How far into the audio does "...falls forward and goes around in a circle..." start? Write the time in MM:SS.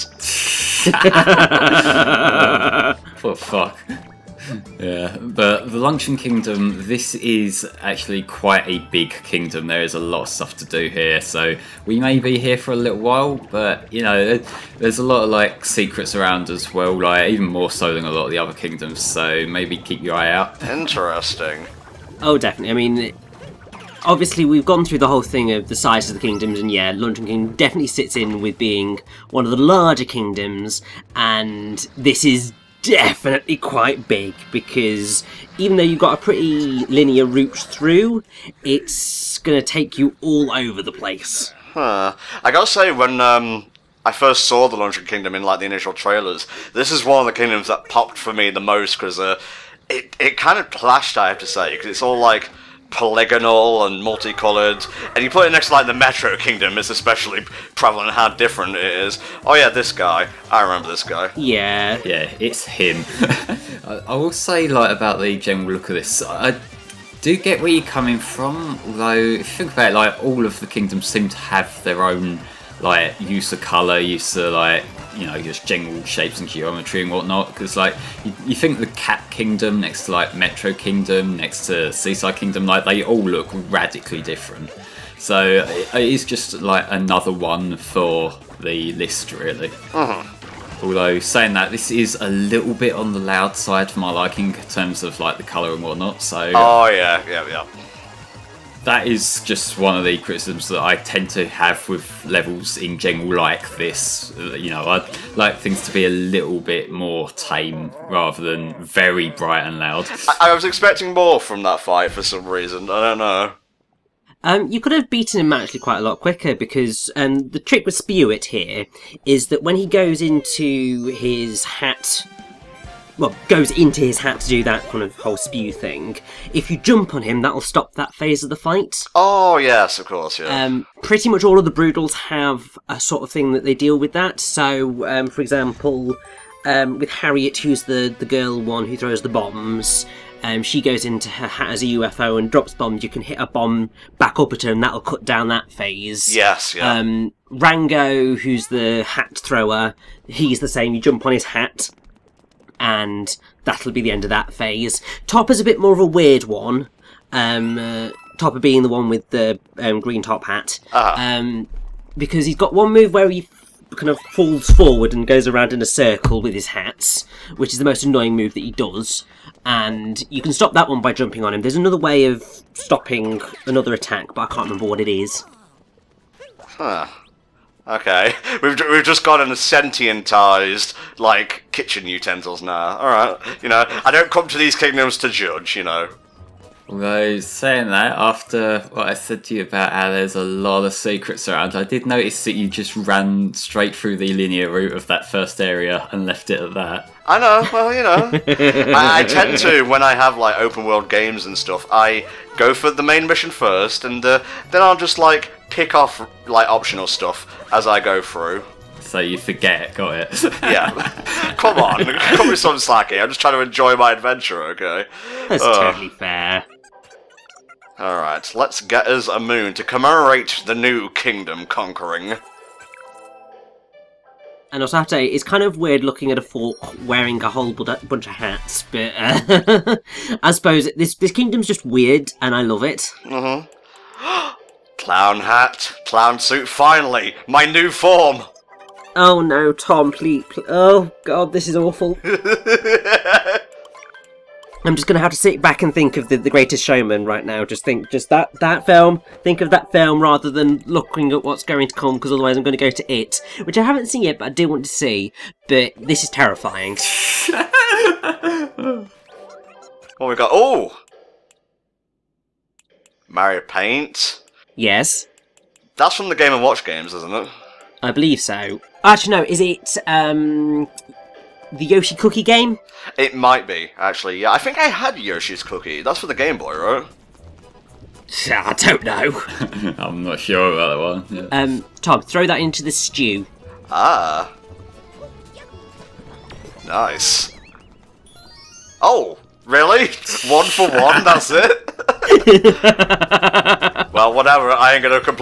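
02:44.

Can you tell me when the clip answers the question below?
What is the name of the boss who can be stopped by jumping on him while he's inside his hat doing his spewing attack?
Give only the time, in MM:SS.
01:57.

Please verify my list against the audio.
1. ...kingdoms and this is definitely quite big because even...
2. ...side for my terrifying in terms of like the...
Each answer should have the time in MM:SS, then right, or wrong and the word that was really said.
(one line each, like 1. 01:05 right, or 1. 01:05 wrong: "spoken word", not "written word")
1. 00:30 right
2. 01:33 wrong: "liking", not "terrifying".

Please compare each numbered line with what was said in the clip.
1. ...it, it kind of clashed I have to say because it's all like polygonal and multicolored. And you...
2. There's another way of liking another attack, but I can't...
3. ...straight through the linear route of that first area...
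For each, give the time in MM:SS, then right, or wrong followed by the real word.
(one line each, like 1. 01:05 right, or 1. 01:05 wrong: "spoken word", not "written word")
1. 00:49 right
2. 02:51 wrong: "stopping", not "liking"
3. 03:13 right.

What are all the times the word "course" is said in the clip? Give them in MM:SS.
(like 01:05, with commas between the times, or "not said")
02:10.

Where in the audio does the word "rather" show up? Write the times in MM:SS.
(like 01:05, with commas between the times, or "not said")
01:48, 04:10.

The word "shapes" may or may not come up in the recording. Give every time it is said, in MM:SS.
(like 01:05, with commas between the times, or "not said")
01:16.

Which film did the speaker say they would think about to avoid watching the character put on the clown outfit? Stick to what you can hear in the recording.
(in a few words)
The Greatest Showman.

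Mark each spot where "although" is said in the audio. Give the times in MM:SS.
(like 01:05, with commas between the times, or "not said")
01:30, 03:06.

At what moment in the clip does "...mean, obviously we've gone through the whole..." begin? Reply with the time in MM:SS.
00:22.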